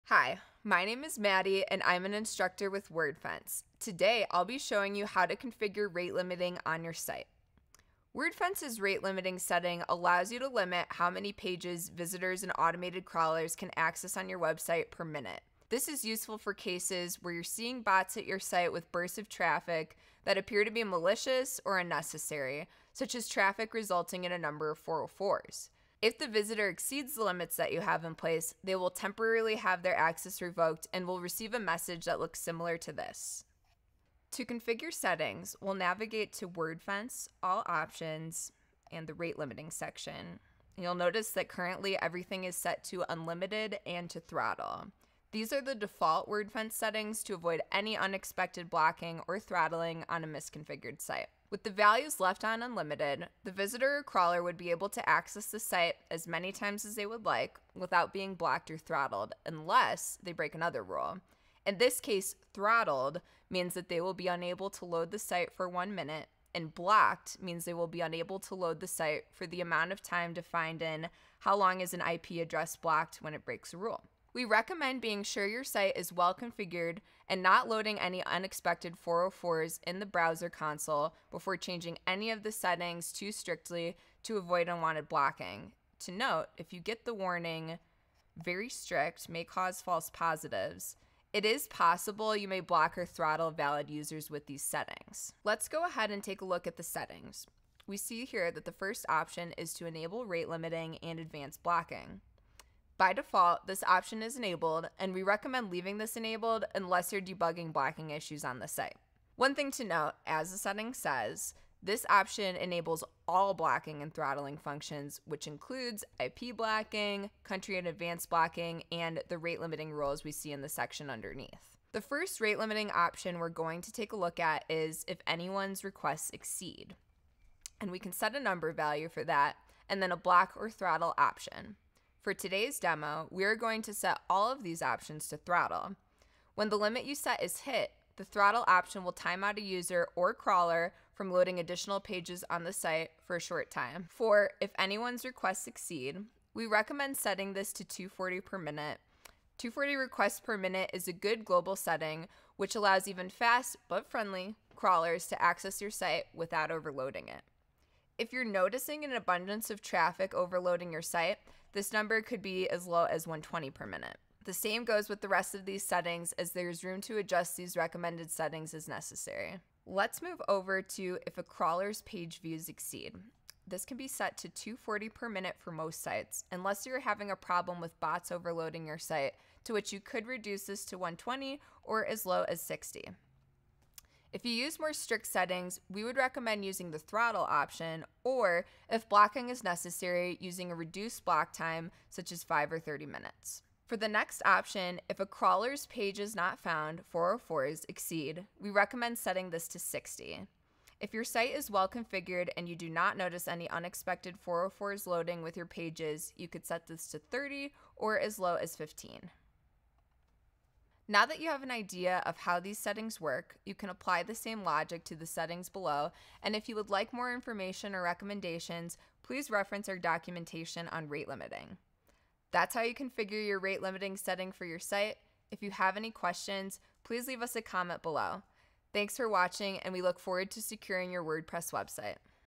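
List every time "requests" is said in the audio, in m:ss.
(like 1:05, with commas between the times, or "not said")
2:05, 2:25, 2:29.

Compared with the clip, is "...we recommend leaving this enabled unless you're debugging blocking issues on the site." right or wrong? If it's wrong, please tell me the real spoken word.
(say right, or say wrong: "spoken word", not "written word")
right.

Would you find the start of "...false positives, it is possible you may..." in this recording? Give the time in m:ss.
1:29.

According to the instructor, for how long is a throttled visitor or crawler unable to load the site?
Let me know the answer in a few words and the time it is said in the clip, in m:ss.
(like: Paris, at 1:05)
one minute, at 1:05.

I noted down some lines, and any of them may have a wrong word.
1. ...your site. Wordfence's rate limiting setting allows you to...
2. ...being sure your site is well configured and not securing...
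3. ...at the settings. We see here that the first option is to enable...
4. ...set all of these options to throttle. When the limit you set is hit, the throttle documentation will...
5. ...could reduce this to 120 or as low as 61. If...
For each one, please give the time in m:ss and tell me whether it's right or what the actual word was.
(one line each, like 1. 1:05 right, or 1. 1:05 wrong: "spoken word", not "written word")
1. 0:06 right
2. 1:15 wrong: "loading", not "securing"
3. 1:36 right
4. 2:13 wrong: "option", not "documentation"
5. 2:59 wrong: "60", not "61".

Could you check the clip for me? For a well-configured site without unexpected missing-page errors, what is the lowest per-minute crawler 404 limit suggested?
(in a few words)
15.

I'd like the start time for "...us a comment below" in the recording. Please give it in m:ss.
3:47.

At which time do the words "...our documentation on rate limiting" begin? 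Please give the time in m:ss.
3:39.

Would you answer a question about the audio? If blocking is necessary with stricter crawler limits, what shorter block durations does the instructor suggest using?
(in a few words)
5 or 30 minutes.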